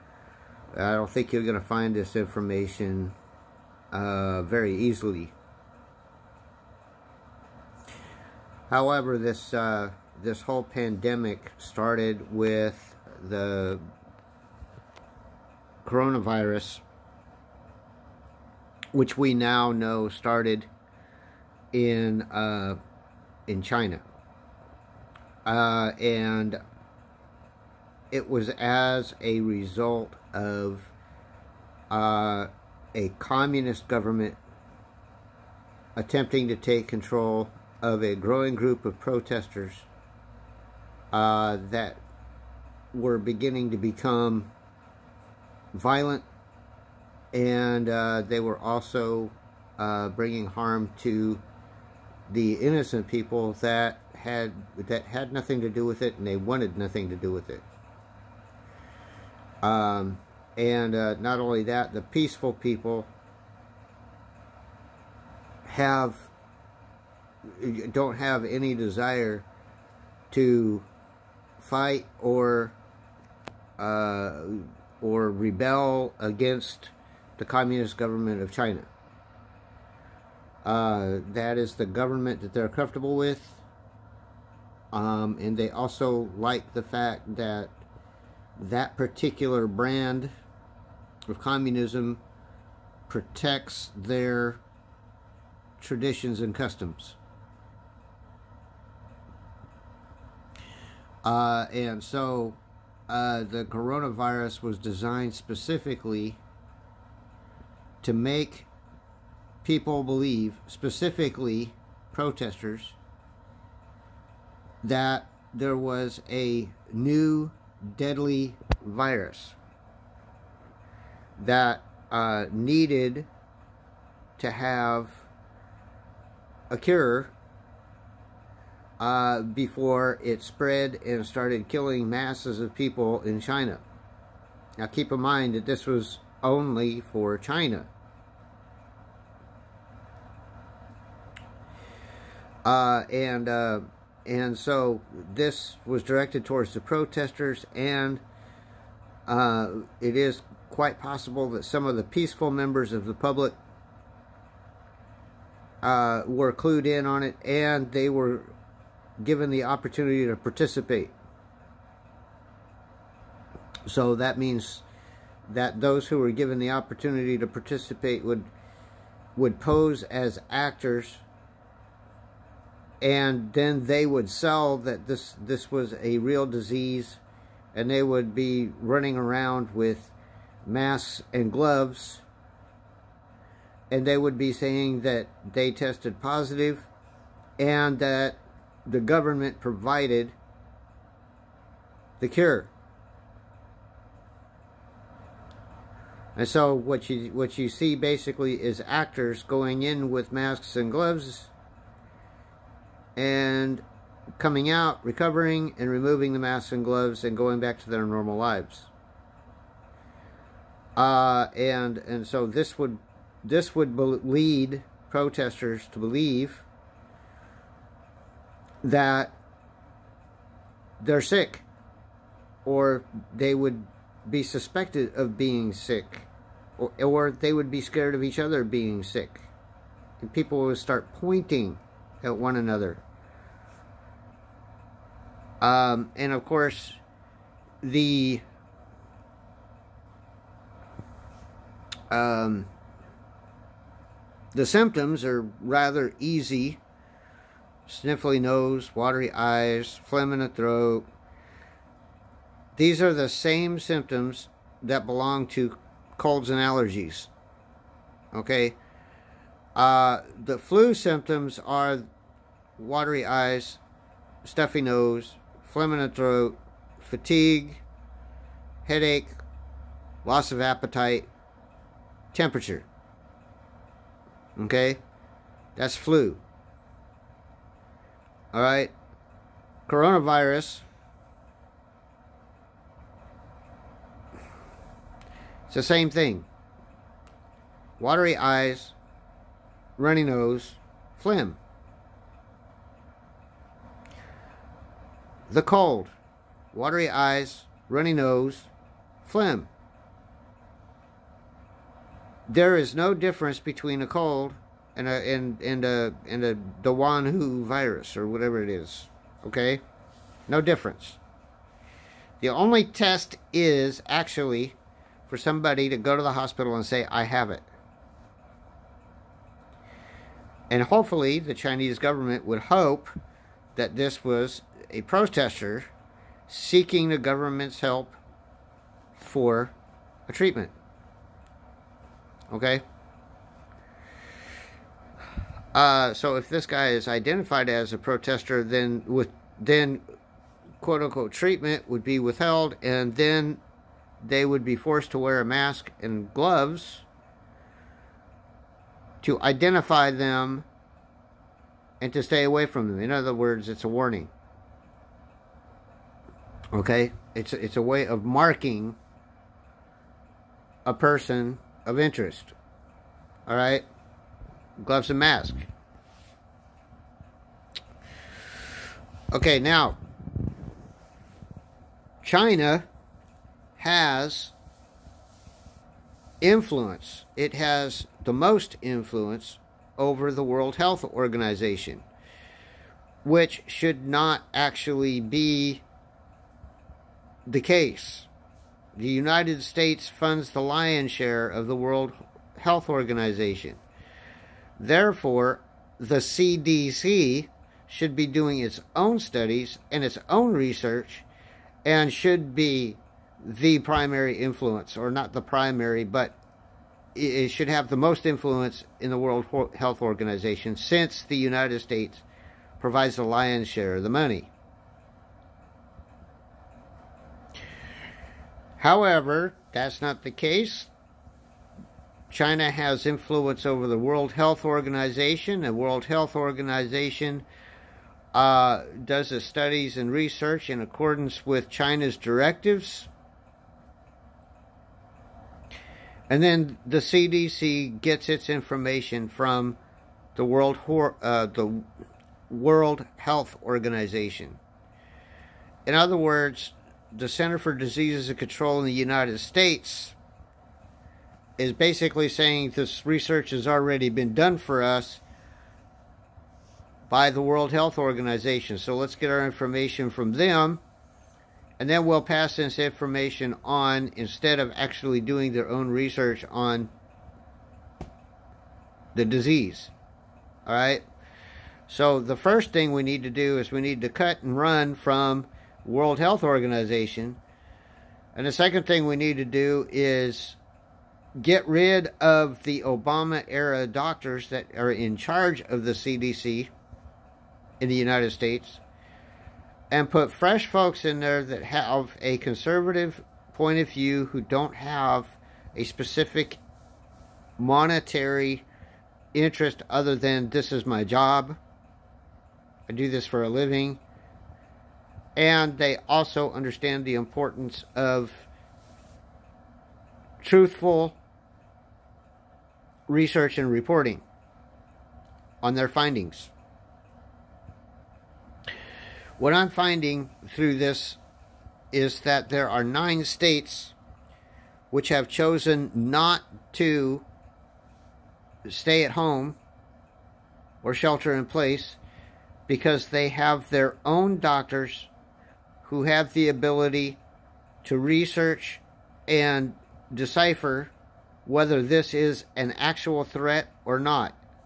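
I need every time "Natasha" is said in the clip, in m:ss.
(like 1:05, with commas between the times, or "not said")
not said.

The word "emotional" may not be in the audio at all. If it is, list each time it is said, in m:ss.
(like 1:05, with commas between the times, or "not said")
not said.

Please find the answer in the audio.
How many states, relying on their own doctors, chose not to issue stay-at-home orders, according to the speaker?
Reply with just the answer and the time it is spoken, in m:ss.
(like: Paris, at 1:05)
9, at 8:42.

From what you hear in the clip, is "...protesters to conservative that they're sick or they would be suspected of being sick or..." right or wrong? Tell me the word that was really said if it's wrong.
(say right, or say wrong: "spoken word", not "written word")
wrong: "believe", not "conservative".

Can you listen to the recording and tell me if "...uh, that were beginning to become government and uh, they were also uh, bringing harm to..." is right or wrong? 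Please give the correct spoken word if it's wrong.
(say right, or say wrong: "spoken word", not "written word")
wrong: "violent", not "government".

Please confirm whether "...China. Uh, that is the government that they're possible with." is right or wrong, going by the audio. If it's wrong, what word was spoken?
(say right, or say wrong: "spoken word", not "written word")
wrong: "comfortable", not "possible".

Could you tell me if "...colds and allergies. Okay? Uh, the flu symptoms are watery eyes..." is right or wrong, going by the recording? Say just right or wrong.
right.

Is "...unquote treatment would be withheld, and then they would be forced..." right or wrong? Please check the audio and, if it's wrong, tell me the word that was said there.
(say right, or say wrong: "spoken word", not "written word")
right.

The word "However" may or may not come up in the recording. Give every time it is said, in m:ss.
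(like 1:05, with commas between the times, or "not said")
0:08, 6:58.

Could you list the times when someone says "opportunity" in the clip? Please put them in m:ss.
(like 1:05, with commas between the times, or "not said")
2:39, 2:46.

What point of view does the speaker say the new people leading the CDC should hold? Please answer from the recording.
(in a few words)
conservative.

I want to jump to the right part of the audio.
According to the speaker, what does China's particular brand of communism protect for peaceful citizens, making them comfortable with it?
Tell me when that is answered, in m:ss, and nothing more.
1:35.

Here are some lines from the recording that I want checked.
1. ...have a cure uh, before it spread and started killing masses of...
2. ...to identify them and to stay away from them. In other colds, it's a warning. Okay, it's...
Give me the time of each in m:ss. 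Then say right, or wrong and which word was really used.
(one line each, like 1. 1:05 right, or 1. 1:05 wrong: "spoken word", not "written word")
1. 2:04 right
2. 5:49 wrong: "words", not "colds".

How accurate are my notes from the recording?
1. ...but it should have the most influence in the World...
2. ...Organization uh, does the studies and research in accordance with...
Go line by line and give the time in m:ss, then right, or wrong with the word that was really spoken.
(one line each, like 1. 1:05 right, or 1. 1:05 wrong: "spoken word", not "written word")
1. 6:46 right
2. 7:06 right.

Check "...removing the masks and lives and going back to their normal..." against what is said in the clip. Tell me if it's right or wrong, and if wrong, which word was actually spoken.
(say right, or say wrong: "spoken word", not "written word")
wrong: "gloves", not "lives".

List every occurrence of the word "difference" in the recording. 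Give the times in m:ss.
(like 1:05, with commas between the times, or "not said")
5:03, 5:10.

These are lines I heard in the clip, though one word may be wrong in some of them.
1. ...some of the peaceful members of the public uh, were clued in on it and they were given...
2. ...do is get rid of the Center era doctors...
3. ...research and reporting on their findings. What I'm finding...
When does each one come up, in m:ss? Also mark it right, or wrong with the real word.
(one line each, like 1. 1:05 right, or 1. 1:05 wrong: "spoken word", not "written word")
1. 2:31 right
2. 7:59 wrong: "Obama", not "Center"
3. 8:33 right.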